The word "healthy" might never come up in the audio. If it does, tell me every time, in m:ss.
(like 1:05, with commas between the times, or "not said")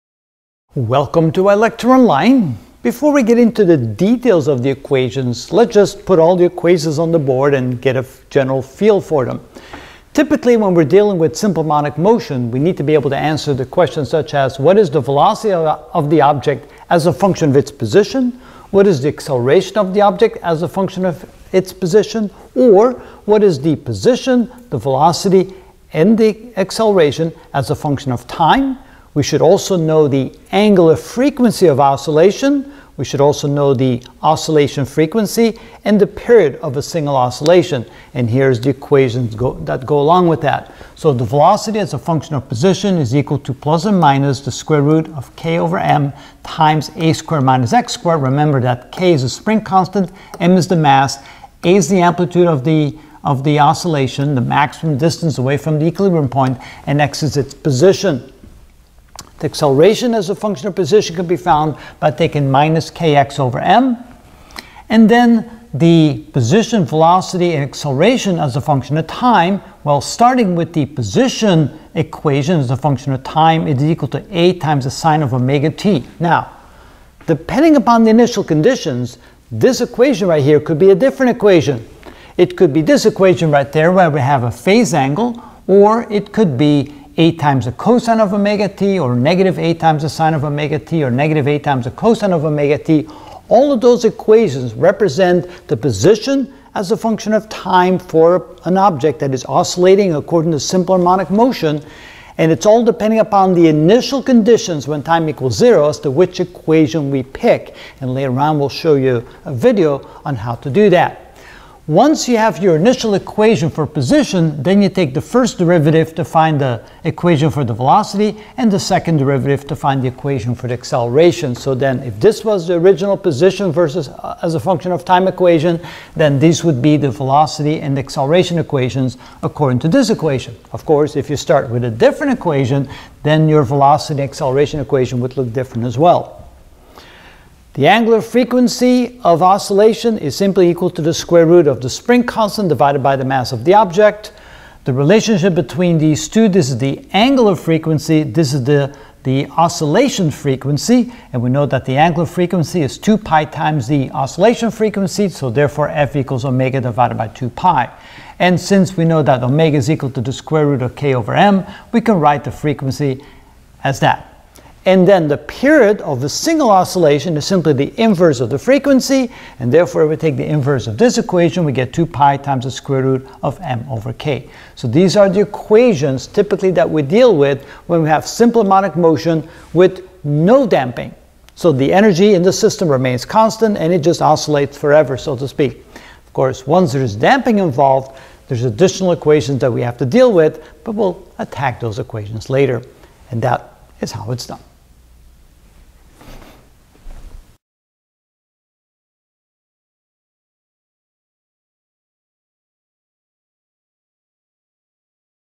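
not said.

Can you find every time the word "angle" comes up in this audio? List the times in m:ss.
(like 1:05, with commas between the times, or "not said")
1:24.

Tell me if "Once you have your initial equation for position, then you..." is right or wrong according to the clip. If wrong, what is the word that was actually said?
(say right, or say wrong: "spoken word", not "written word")
right.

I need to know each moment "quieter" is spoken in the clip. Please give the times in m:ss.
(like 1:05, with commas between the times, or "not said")
not said.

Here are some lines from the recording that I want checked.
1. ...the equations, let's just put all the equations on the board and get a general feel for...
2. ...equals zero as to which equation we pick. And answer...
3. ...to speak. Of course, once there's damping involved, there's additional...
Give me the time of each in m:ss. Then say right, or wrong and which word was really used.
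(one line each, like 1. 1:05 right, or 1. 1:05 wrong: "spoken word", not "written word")
1. 0:04 right
2. 1:45 wrong: "later", not "answer"
3. 3:05 right.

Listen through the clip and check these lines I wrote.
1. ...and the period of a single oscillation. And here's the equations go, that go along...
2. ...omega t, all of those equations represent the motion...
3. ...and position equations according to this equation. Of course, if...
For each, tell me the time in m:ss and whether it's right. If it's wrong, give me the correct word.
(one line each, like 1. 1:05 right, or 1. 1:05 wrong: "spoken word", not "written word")
1. 0:35 right
2. 1:32 wrong: "position", not "motion"
3. 2:07 wrong: "acceleration", not "position".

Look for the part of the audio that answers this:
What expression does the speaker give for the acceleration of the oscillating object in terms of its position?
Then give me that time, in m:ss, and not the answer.
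1:02.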